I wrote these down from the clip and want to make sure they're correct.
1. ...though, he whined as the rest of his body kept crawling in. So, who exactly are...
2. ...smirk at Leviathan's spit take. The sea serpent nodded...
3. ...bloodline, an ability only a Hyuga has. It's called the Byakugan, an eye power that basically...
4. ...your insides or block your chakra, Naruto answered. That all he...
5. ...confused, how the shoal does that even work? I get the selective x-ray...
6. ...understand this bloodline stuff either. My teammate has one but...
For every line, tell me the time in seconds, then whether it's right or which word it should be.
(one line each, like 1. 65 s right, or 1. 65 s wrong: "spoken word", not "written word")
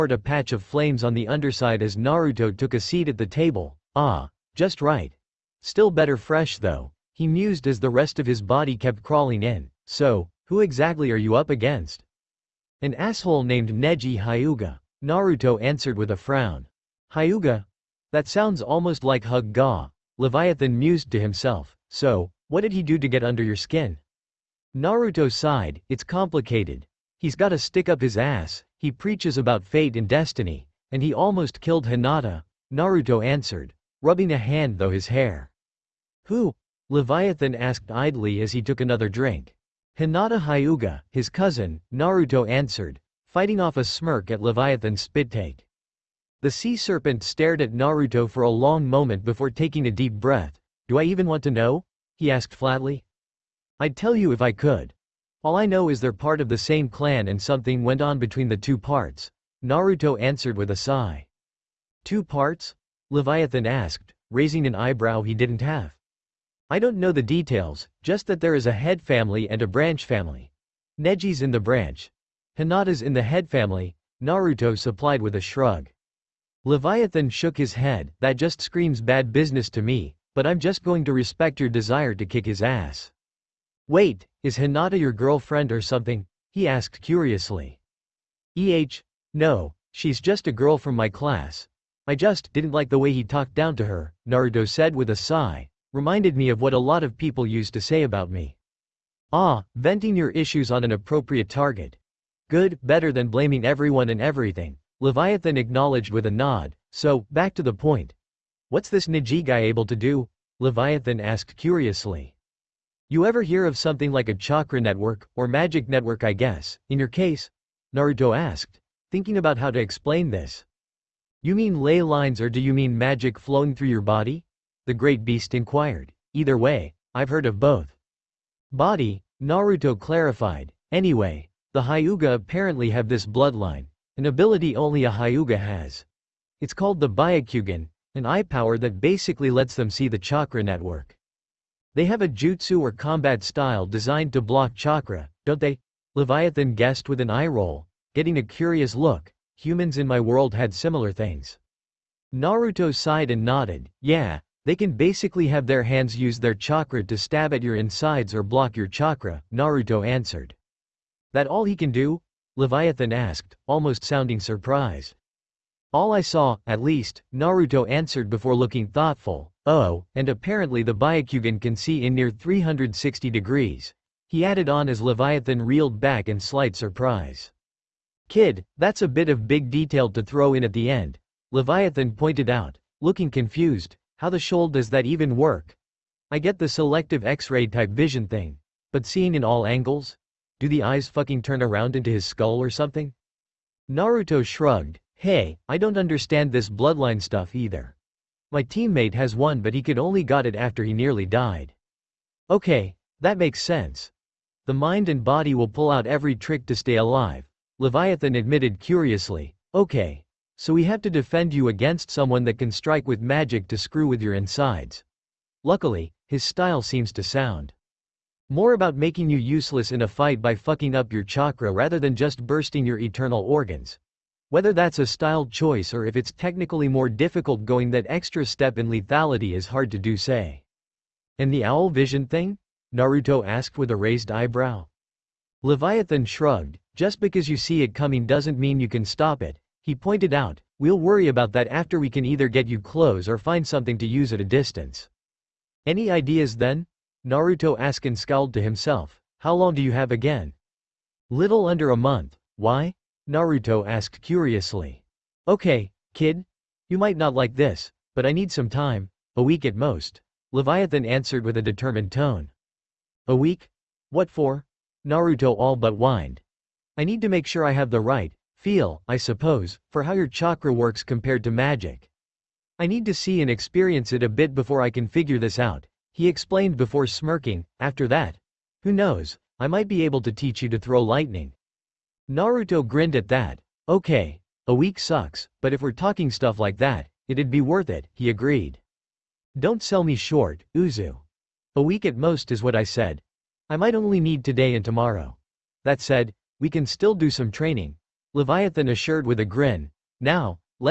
1. 6 s wrong: "mused", not "whined"
2. 43 s wrong: "stared", not "nodded"
3. 133 s right
4. 157 s right
5. 183 s right
6. 195 s right.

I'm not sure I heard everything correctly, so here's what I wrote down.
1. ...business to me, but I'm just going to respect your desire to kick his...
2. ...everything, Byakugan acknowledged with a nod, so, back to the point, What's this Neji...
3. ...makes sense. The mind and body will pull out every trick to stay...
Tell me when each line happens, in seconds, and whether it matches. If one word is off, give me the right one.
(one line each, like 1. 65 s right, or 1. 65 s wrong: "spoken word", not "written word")
1. 79 s right
2. 104 s wrong: "Leviathan", not "Byakugan"
3. 203 s right.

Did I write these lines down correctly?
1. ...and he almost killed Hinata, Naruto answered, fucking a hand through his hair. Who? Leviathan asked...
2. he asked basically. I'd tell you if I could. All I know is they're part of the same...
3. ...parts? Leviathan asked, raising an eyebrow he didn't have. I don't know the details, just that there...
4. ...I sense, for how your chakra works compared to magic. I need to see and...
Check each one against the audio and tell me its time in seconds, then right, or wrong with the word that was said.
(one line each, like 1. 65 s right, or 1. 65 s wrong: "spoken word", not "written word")
1. 30 s wrong: "rubbing", not "fucking"
2. 52 s wrong: "flatly", not "basically"
3. 62 s right
4. 269 s wrong: "suppose", not "sense".